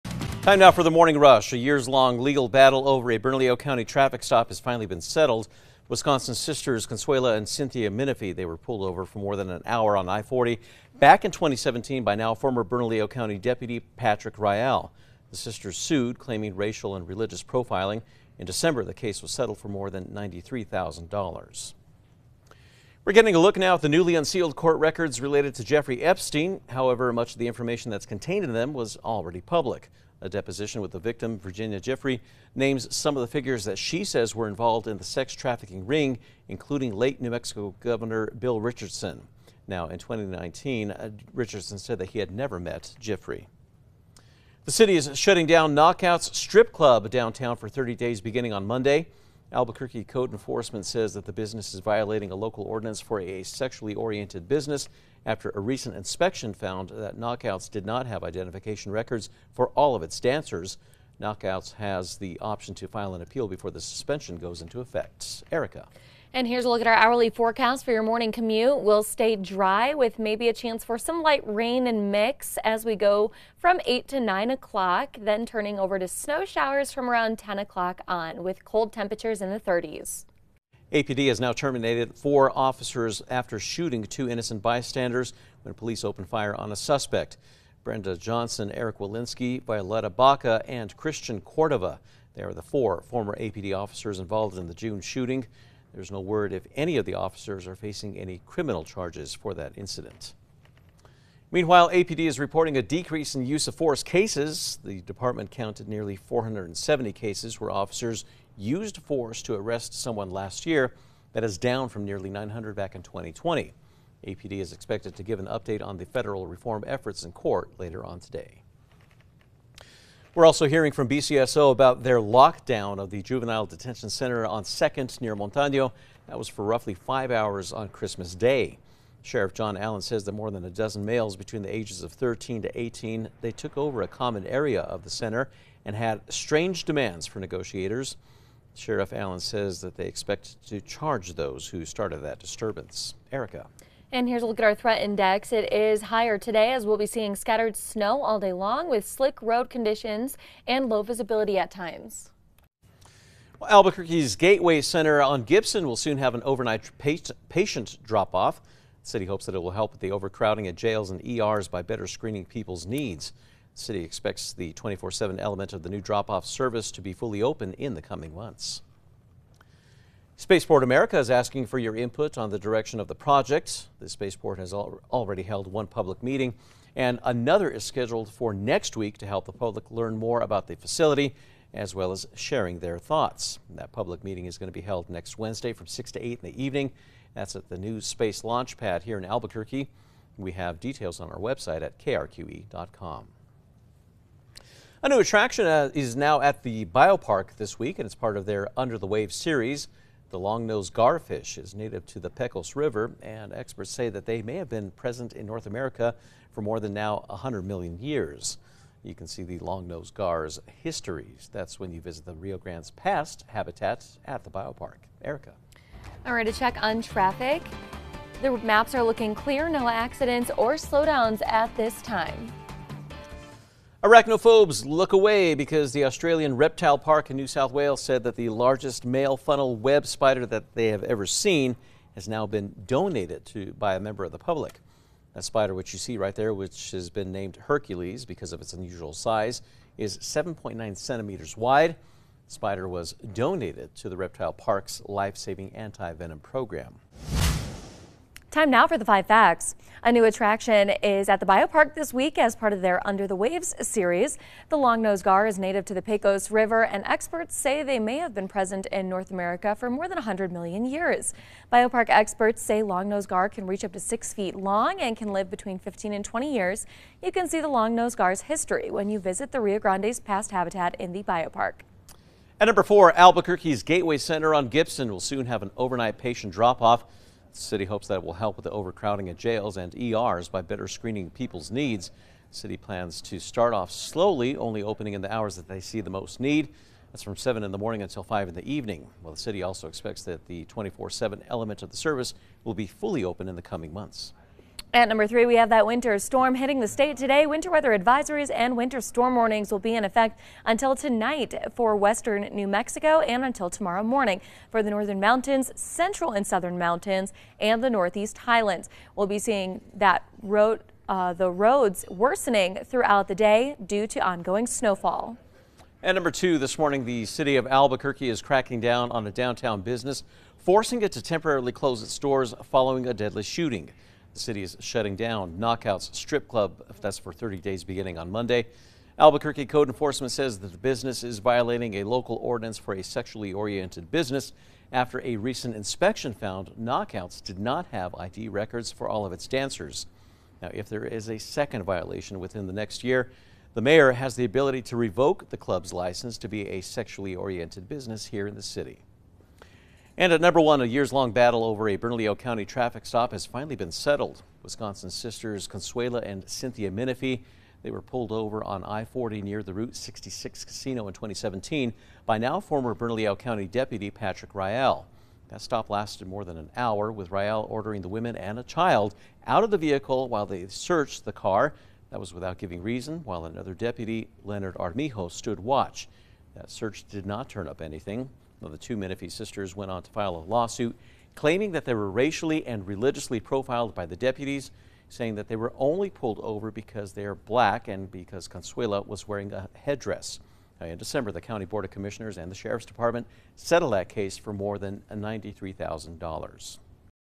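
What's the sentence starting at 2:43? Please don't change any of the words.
The city expects the 24 7 element of the new drop off service to be fully open in the coming months.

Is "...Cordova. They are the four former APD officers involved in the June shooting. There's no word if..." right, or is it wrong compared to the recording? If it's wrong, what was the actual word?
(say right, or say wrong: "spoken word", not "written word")
right.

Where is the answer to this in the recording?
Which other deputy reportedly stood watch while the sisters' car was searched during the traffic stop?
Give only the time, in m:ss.
6:14.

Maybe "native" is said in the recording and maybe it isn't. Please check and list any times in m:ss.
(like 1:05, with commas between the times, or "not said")
3:21, 4:15.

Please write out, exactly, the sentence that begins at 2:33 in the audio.
Well, Albuquerque's Gateway Center on Gibson will soon have an overnight patient drop off.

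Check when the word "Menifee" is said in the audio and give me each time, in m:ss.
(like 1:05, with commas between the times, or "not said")
0:07, 5:56, 6:18.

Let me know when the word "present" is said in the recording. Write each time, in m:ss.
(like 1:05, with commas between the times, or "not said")
3:24, 4:18.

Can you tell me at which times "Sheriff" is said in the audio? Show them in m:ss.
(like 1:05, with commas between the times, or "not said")
2:09, 2:18, 6:32.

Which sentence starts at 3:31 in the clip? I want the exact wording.
That's when you visit the Rio Grande's past habitat at the biopark.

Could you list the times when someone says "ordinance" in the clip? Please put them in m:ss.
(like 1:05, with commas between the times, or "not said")
0:52, 5:32.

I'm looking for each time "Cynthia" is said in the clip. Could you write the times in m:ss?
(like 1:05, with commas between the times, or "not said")
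0:07, 5:56.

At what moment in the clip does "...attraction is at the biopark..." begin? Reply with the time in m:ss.
4:10.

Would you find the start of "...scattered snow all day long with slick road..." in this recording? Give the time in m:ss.
2:27.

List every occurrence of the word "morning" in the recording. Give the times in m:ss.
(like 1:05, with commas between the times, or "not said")
0:00, 1:08, 4:47, 5:04, 5:16.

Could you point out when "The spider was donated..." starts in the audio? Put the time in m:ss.
4:02.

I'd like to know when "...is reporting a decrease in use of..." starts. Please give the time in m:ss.
1:42.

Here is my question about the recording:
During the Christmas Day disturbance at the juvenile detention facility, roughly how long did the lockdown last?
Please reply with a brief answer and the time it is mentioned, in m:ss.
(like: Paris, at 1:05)
five hours, at 2:06.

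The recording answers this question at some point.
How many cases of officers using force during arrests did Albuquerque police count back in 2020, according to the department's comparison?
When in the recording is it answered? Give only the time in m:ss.
1:52.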